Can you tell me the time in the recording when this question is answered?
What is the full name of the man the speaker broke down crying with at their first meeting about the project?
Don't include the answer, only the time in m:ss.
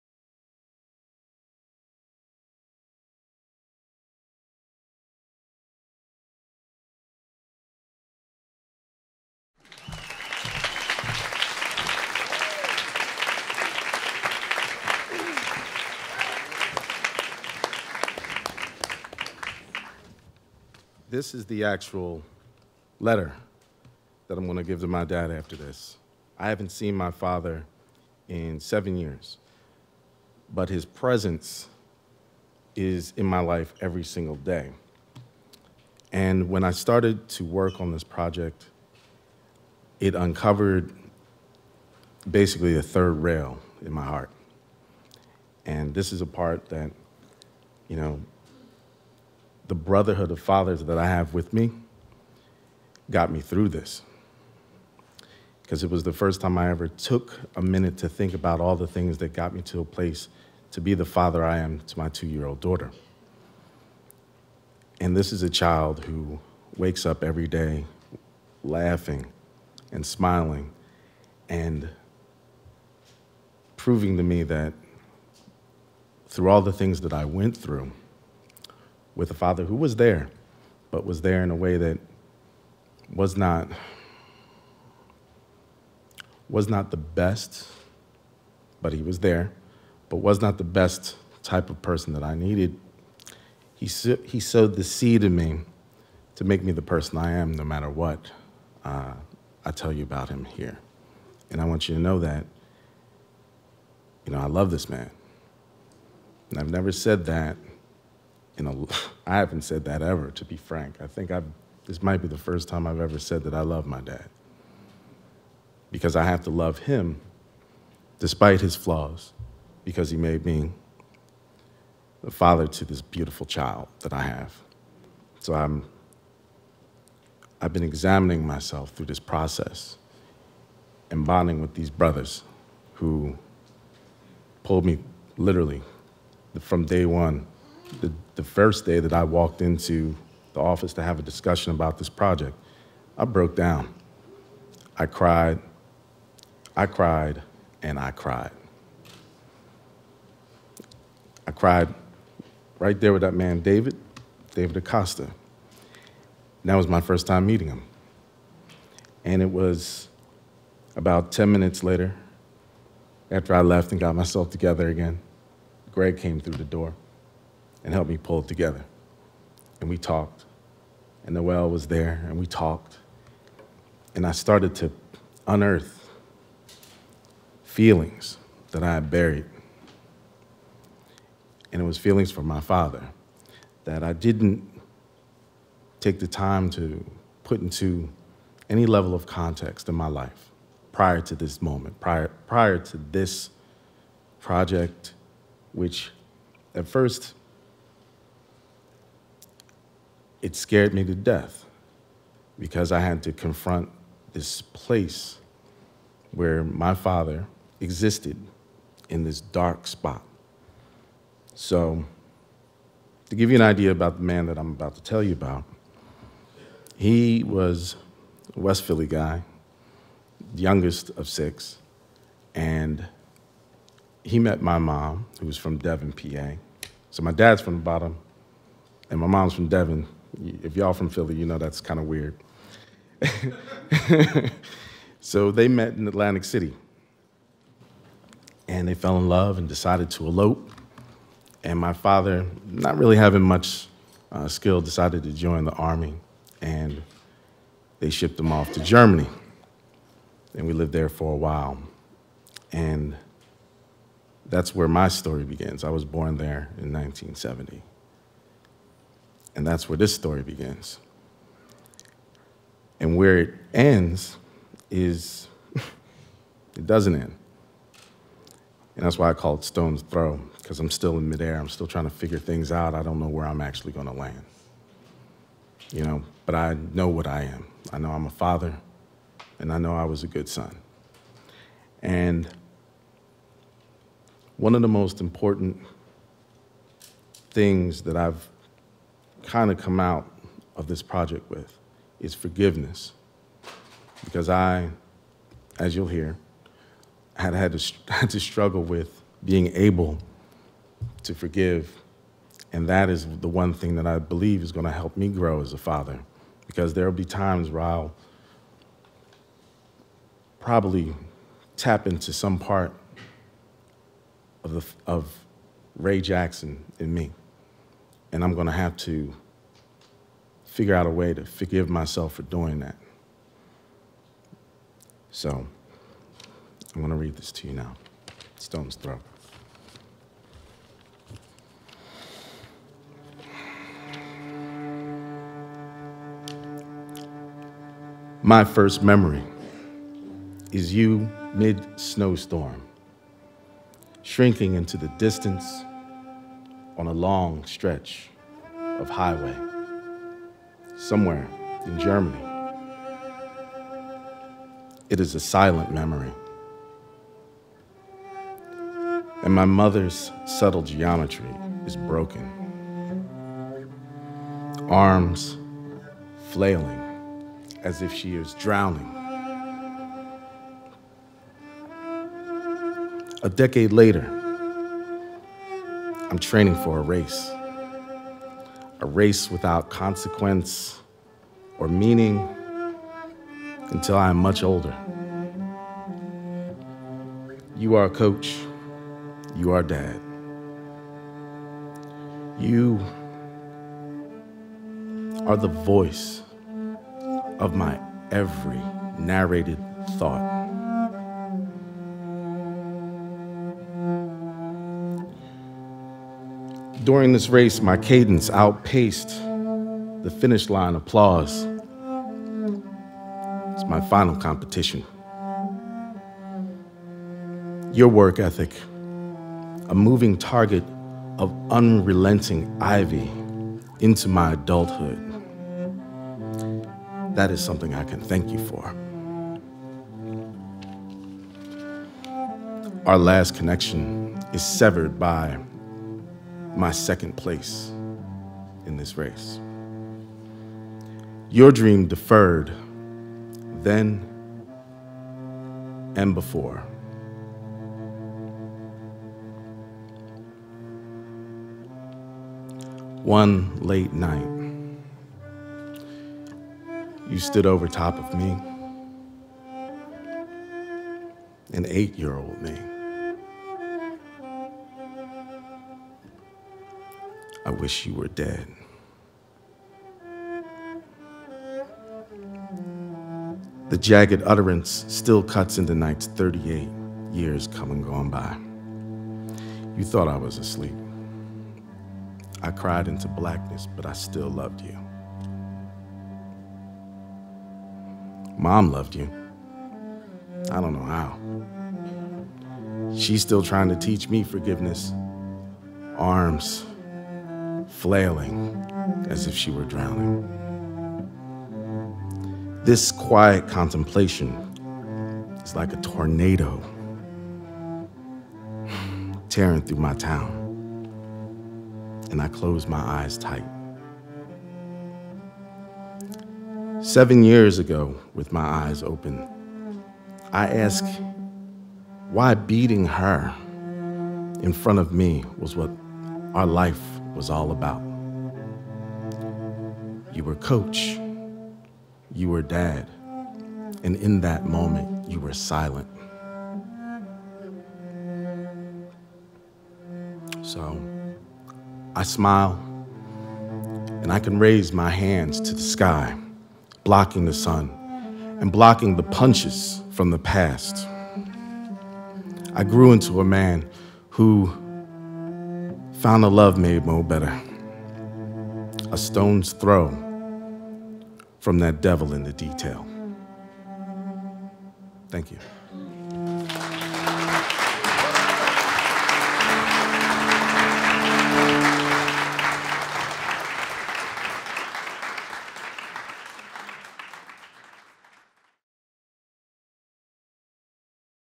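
2:34.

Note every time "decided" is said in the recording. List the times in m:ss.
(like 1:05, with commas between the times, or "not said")
3:59, 4:04.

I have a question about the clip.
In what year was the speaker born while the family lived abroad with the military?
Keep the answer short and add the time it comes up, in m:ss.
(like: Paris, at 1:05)
1970, at 4:16.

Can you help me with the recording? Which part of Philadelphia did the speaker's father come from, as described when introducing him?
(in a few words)
West Philly.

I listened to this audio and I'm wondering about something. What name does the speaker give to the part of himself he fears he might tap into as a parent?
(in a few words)
Ray Jackson.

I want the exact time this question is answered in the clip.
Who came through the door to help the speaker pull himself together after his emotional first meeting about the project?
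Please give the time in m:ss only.
2:45.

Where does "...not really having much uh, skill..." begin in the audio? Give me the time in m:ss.
4:02.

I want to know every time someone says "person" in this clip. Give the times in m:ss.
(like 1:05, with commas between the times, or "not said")
1:31, 1:36.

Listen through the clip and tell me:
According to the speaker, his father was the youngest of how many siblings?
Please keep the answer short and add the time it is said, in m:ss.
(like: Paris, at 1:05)
6, at 3:41.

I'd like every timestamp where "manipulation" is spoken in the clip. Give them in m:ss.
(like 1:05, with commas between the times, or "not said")
not said.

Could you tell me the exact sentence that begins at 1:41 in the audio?
And I want you to know that, you know, I love this man.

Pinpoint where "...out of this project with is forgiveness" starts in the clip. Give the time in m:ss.
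4:49.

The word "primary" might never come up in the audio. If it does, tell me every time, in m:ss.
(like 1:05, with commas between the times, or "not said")
not said.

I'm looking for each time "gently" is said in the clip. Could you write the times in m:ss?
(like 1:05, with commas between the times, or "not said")
not said.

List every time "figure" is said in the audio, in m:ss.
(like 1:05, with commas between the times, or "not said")
4:32, 5:20.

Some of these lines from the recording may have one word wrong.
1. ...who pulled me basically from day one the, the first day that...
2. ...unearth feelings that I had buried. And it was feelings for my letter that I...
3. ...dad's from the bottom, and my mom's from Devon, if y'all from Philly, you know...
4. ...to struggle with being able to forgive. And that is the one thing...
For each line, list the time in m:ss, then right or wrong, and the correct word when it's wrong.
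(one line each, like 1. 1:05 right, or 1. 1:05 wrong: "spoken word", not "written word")
1. 2:12 wrong: "literally", not "basically"
2. 2:55 wrong: "father", not "letter"
3. 3:47 right
4. 4:58 right.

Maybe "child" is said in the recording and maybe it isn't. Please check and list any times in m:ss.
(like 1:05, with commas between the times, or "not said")
1:05, 2:03.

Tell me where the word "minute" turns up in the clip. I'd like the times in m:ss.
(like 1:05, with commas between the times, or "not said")
0:57, 2:41.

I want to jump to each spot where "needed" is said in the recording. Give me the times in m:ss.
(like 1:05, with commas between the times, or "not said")
1:32.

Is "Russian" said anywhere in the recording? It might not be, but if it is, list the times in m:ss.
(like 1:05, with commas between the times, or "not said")
not said.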